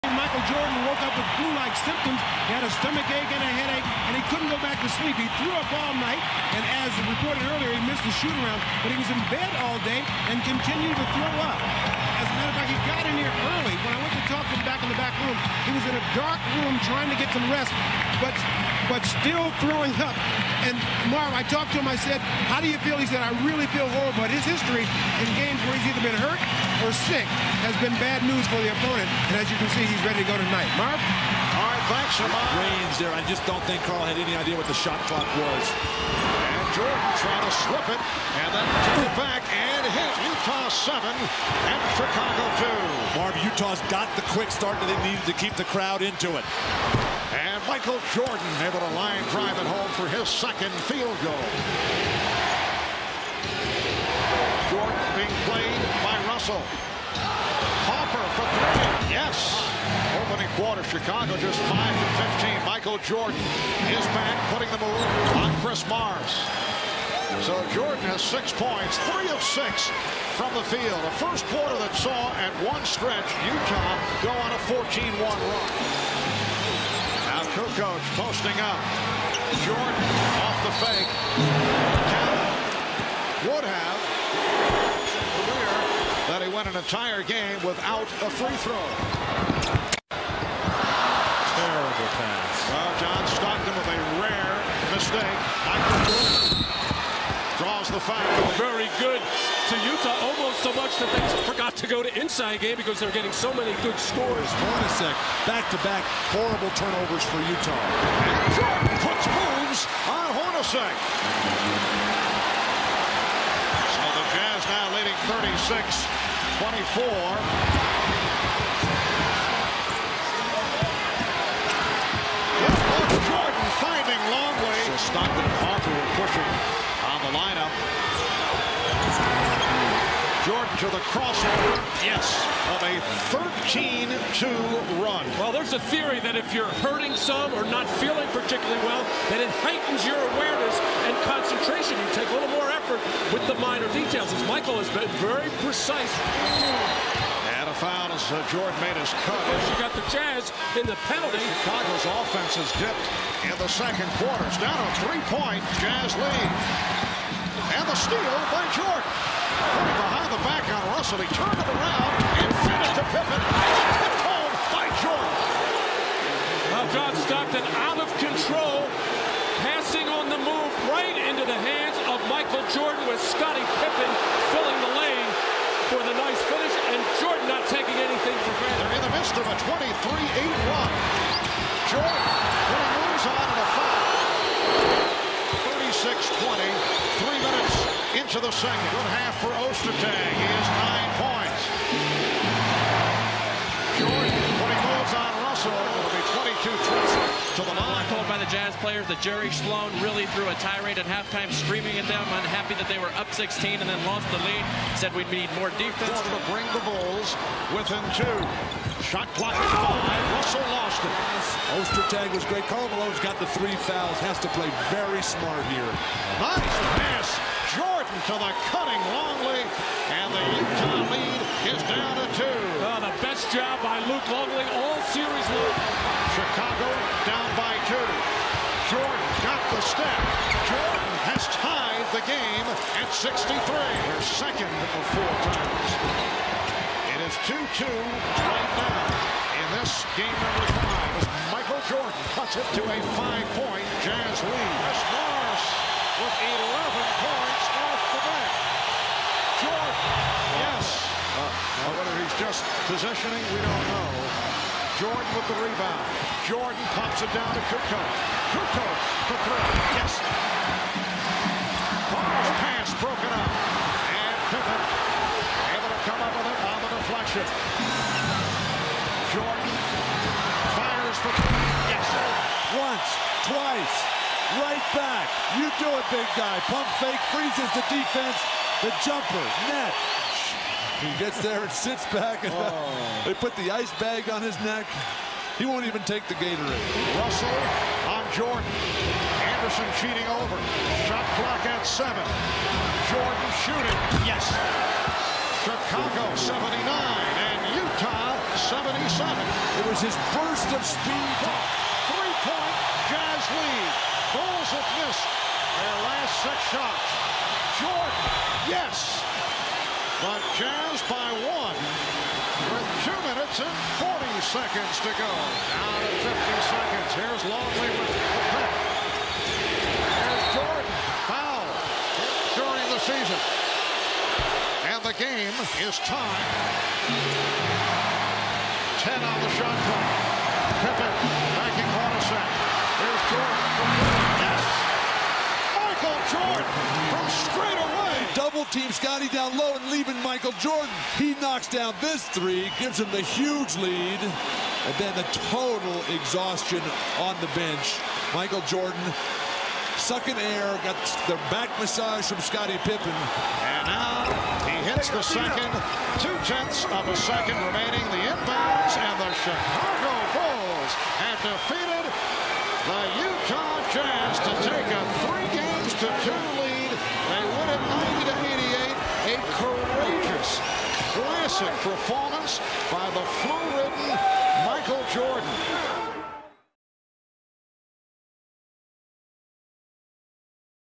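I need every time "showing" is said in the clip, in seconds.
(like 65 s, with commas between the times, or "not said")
not said.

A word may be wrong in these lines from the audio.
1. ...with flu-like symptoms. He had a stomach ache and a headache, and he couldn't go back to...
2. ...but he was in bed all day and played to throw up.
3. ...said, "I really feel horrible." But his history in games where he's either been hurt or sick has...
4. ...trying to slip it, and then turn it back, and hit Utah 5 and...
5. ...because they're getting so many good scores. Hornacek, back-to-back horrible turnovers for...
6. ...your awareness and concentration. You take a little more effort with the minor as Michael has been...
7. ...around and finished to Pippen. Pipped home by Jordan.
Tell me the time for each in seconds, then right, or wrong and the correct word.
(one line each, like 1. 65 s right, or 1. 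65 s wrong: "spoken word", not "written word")
1. 1 s right
2. 8 s wrong: "continued", not "played"
3. 23 s right
4. 37 s wrong: "7", not "5"
5. 102 s right
6. 140 s right
7. 161 s right.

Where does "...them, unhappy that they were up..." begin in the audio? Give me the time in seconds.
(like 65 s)
202 s.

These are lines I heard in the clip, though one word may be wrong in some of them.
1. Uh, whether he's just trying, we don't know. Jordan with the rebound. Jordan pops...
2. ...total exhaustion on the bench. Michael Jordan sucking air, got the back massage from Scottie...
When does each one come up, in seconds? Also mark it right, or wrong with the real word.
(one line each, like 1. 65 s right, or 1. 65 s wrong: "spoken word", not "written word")
1. 251 s wrong: "positioning", not "trying"
2. 345 s right.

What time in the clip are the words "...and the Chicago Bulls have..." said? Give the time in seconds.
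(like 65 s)
358 s.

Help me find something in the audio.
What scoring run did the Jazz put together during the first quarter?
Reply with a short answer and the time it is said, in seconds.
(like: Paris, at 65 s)
14-1, at 74 s.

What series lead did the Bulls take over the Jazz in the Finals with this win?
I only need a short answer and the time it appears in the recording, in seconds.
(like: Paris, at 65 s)
3 games to 2, at 365 s.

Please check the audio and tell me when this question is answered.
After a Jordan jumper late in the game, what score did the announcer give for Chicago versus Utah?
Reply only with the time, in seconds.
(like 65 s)
295 s.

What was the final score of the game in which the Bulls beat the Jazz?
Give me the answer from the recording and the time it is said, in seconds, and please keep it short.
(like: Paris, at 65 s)
90-88, at 368 s.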